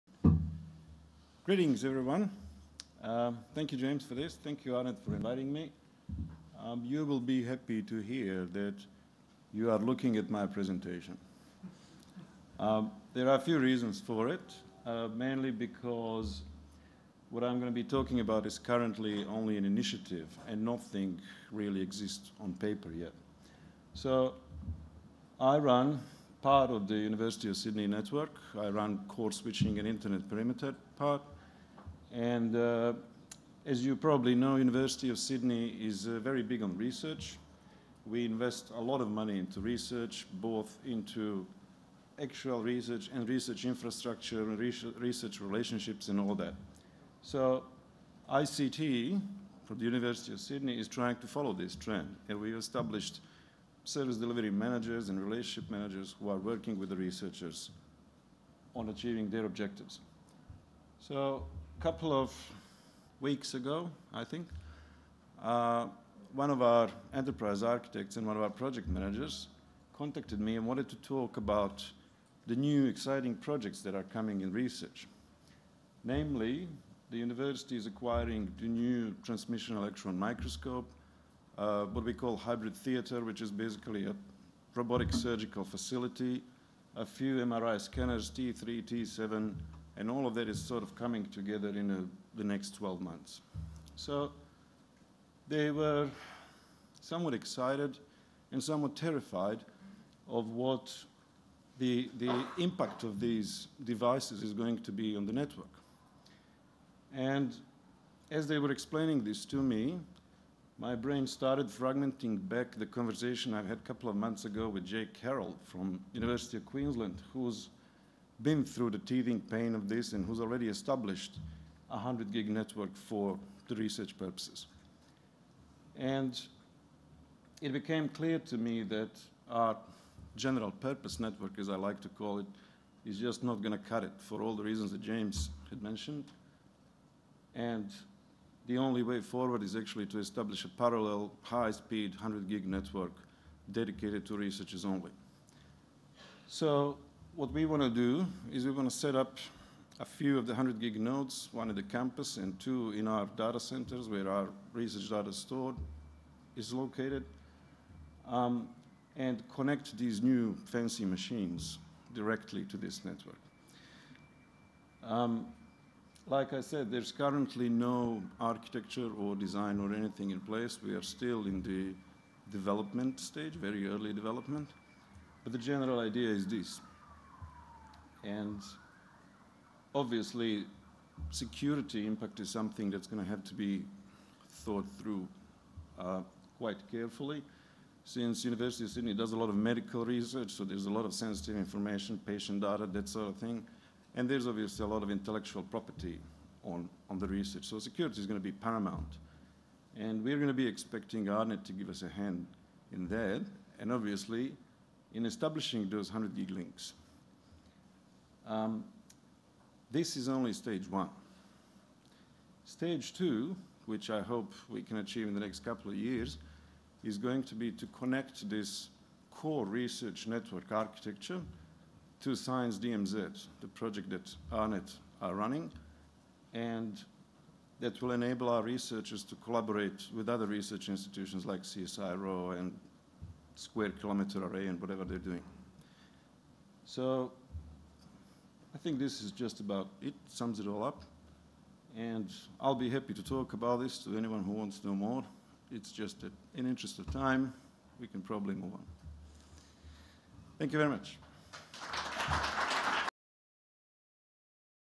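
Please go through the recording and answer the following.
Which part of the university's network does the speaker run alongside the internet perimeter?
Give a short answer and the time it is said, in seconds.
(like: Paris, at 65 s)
Core switching, at 29 s.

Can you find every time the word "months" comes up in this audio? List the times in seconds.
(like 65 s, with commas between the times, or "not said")
93 s, 114 s.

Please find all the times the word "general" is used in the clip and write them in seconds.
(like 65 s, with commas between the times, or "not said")
130 s, 175 s.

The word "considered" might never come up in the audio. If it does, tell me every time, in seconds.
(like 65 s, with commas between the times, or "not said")
not said.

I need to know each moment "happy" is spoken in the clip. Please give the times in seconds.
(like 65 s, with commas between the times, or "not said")
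7 s, 242 s.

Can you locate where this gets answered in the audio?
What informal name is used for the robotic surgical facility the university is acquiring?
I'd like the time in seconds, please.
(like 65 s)
82 s.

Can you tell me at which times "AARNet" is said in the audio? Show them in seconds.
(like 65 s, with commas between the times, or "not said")
4 s, 201 s, 224 s.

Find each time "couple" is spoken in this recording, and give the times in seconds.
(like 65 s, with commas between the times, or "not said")
61 s, 113 s, 215 s.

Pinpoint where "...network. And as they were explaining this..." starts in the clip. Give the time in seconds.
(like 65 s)
105 s.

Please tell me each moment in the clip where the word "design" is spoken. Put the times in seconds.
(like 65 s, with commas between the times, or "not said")
169 s.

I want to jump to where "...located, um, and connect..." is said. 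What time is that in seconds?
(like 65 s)
156 s.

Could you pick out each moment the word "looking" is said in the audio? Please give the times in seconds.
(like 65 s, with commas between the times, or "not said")
9 s.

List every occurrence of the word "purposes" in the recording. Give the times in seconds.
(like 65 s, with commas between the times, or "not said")
124 s, 130 s.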